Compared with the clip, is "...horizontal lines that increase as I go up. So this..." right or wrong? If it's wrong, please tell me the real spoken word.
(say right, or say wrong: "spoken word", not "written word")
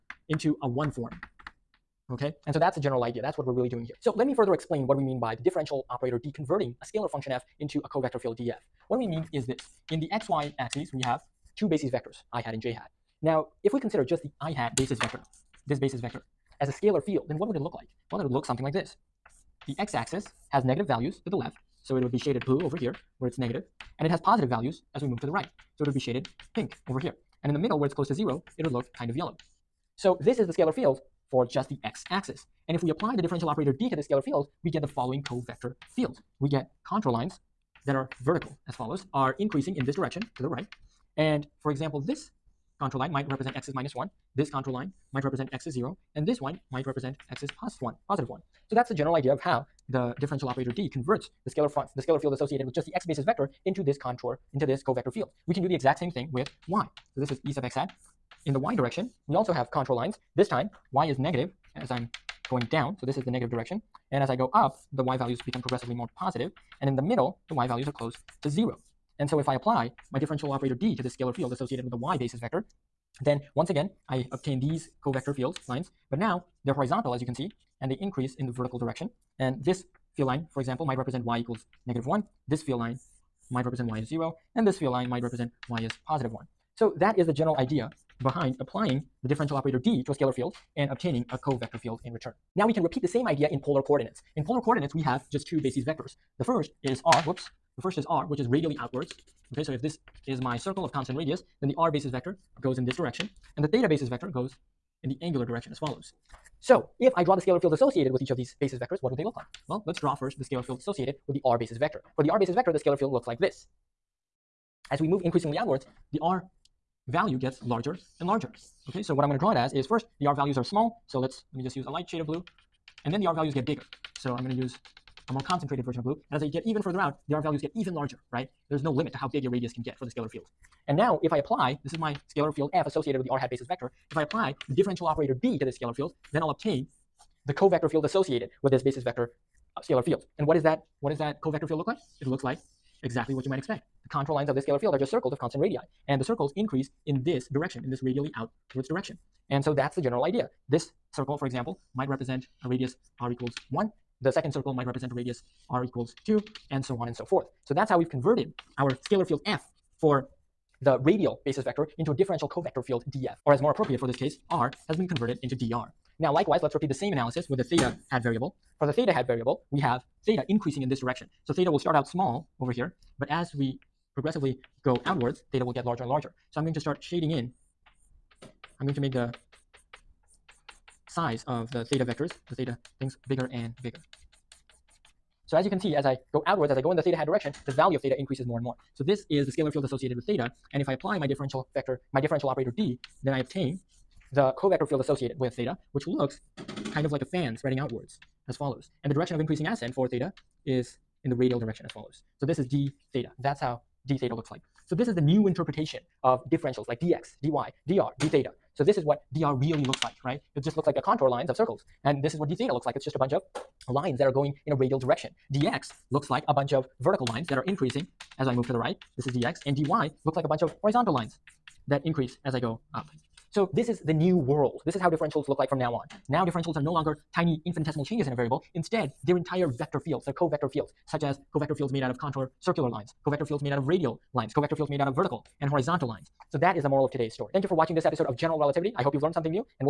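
right.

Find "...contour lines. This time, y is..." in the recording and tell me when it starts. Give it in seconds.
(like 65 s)
59 s.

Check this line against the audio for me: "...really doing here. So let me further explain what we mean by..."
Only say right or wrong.
right.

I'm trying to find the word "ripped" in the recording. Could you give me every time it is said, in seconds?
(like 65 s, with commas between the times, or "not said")
not said.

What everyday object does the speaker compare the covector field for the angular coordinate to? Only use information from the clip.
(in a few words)
a fan.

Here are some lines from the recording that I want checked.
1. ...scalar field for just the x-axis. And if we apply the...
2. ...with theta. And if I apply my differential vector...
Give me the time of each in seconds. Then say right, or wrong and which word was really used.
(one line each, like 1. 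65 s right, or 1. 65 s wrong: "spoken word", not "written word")
1. 30 s right
2. 190 s right.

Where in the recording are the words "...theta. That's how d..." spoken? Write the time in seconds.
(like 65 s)
203 s.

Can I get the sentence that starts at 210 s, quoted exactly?
It just looks like a contour lines of circles.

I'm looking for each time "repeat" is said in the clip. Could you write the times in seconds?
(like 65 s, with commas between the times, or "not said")
92 s, 166 s.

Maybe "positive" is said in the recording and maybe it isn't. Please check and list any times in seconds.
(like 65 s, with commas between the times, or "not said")
24 s, 48 s, 66 s, 86 s.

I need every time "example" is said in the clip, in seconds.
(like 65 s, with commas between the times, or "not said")
41 s, 80 s, 151 s.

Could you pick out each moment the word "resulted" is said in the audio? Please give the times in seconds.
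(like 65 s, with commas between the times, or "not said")
not said.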